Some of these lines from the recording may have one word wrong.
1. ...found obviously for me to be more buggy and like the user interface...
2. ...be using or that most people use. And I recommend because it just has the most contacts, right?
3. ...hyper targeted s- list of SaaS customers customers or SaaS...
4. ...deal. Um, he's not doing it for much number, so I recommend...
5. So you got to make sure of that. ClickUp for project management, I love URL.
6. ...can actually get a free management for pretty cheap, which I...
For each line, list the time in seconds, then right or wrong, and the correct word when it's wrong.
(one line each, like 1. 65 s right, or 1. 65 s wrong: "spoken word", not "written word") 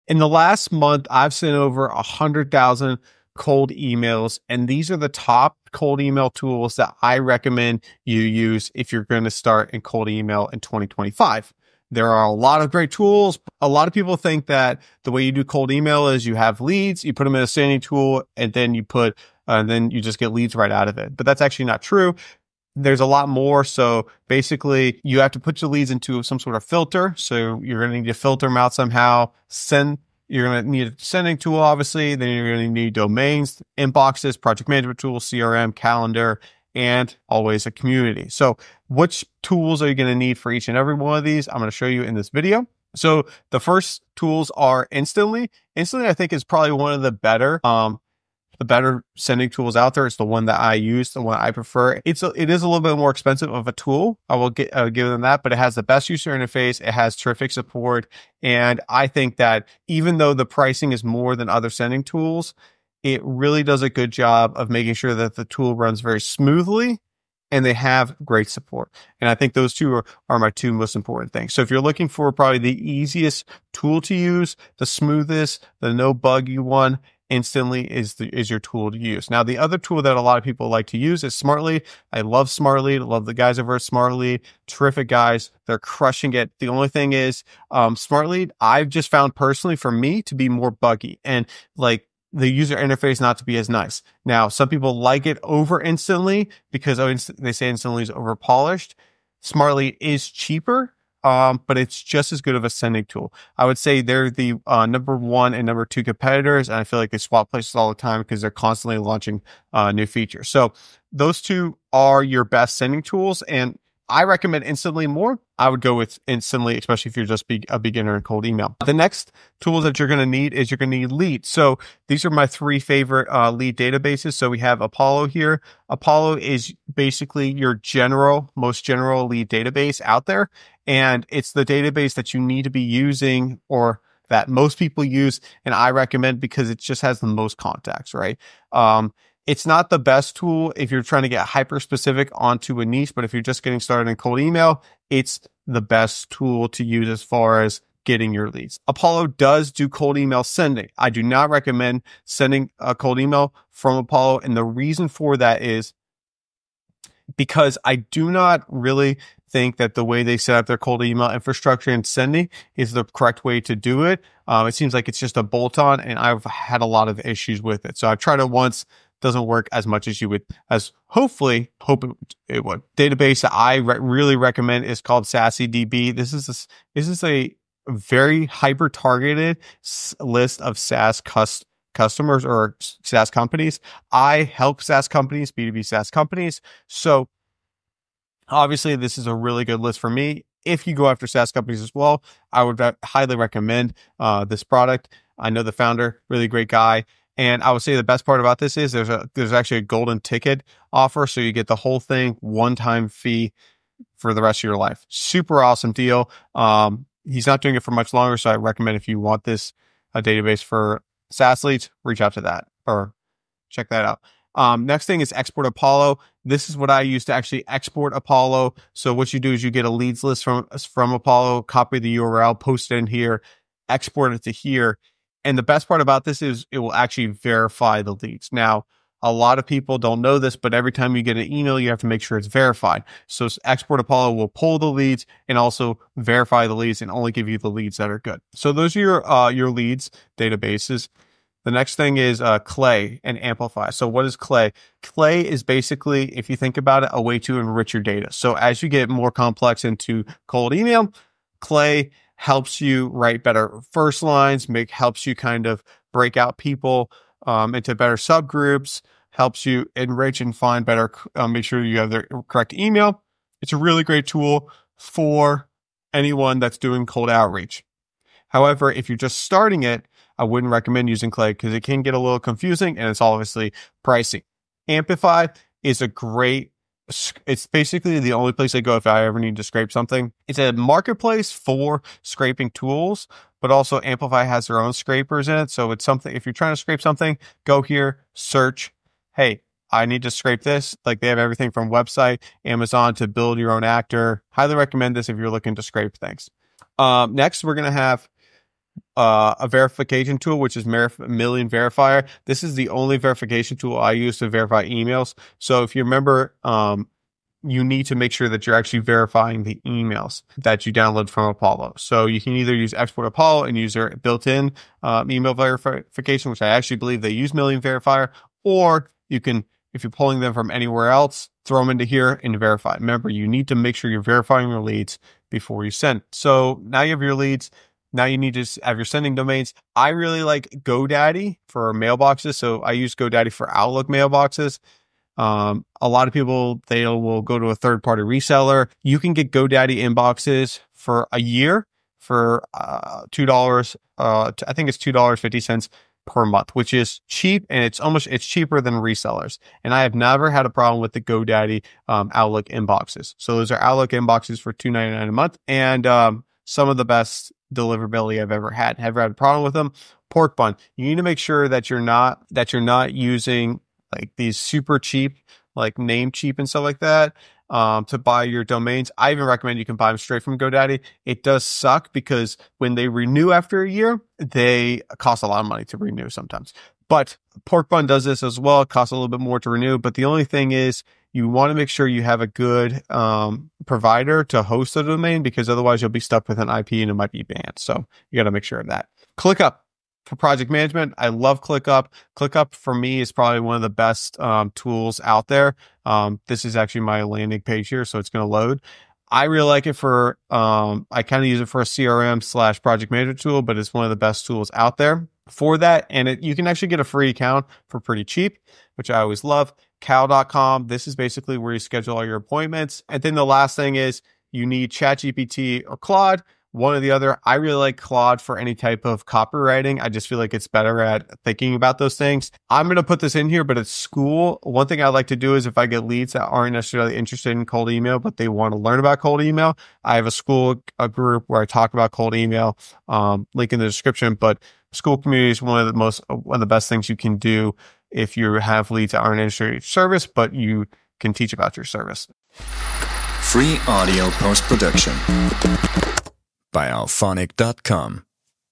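1. 89 s wrong: "personally", not "obviously"
2. 132 s right
3. 178 s right
4. 205 s wrong: "longer", not "number"
5. 387 s wrong: "ClickUp", not "URL"
6. 406 s wrong: "account", not "management".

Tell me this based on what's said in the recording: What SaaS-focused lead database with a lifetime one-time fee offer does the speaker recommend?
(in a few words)
SassyDB.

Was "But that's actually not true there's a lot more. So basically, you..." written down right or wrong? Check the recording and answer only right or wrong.
right.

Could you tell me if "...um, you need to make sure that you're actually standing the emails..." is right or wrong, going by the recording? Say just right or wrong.
wrong.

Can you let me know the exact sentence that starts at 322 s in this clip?
Remember, you need to make sure you're verifying your leads before you send.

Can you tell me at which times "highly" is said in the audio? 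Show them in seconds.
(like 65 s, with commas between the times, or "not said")
193 s, 294 s.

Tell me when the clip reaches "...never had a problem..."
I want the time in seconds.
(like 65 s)
350 s.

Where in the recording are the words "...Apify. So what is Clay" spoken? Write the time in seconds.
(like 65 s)
243 s.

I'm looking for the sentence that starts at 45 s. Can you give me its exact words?
Instantly, I think, is probably one of the better um, the better sending tools out there.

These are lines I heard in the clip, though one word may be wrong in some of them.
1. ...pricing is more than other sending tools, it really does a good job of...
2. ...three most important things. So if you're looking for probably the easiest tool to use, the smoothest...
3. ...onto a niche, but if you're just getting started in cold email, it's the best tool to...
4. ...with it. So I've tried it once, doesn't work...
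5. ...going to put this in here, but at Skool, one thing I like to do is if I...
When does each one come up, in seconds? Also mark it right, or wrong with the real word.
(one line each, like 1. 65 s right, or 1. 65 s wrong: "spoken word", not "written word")
1. 60 s right
2. 70 s wrong: "two", not "three"
3. 142 s right
4. 167 s right
5. 422 s right.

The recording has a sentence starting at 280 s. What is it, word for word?
It's a marketplace for scraping tools, but also Apify has their own scrapers in it.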